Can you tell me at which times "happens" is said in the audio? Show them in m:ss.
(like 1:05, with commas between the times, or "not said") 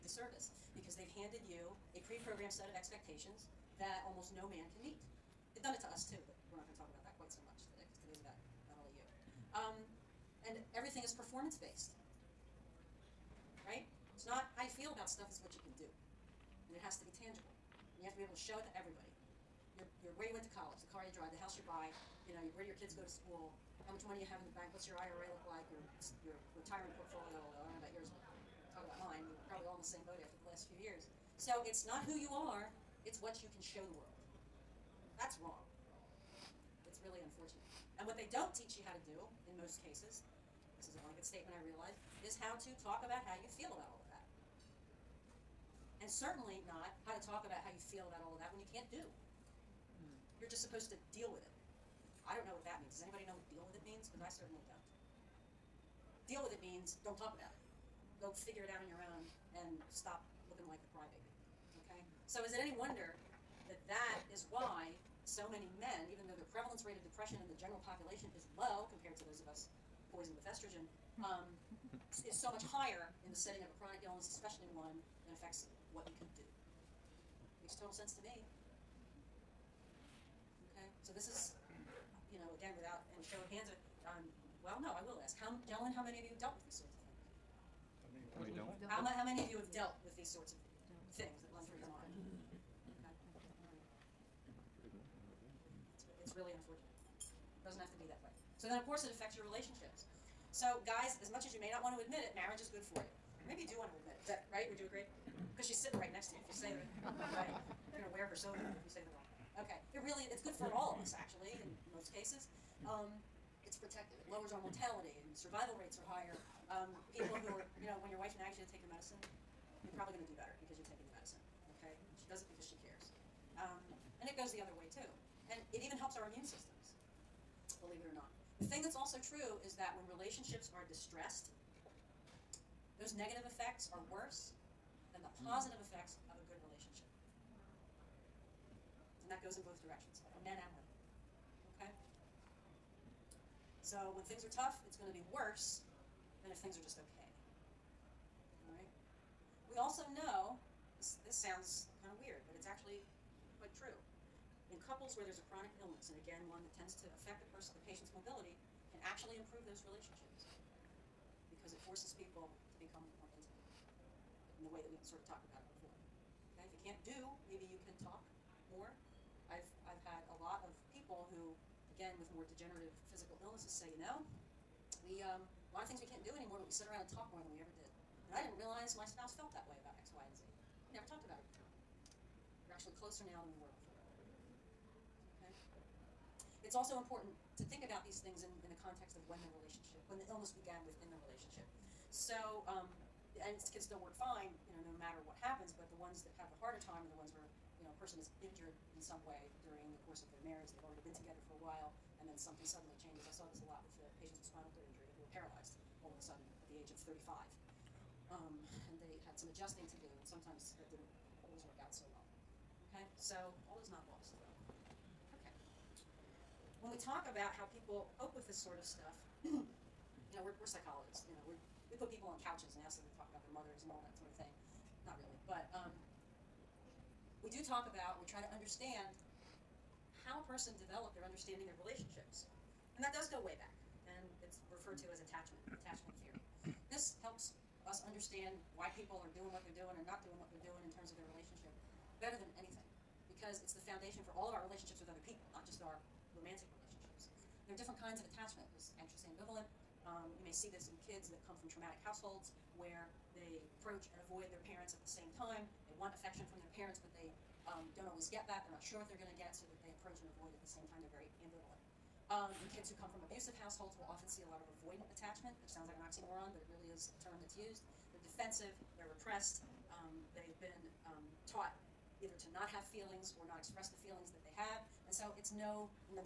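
3:15.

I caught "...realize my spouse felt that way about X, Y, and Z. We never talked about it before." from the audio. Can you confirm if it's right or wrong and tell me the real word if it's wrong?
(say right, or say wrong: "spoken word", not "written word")
right.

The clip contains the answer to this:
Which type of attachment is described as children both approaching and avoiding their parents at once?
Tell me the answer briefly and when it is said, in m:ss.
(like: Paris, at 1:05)
Anxious ambivalent, at 4:08.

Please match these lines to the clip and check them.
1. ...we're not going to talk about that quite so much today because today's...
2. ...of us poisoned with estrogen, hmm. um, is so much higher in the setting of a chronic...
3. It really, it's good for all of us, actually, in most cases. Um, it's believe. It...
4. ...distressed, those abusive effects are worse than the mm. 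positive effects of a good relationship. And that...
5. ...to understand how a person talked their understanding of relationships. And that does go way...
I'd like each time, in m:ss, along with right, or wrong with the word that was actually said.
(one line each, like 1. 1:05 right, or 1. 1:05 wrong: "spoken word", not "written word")
1. 0:06 right
2. 1:09 right
3. 1:49 wrong: "protective", not "believe"
4. 2:10 wrong: "negative", not "abusive"
5. 3:48 wrong: "developed", not "talked".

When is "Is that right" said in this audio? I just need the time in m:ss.
1:44.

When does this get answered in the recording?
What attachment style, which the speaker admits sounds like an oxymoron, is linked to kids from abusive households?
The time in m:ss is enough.
4:24.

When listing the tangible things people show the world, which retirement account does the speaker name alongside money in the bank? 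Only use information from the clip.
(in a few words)
IRA.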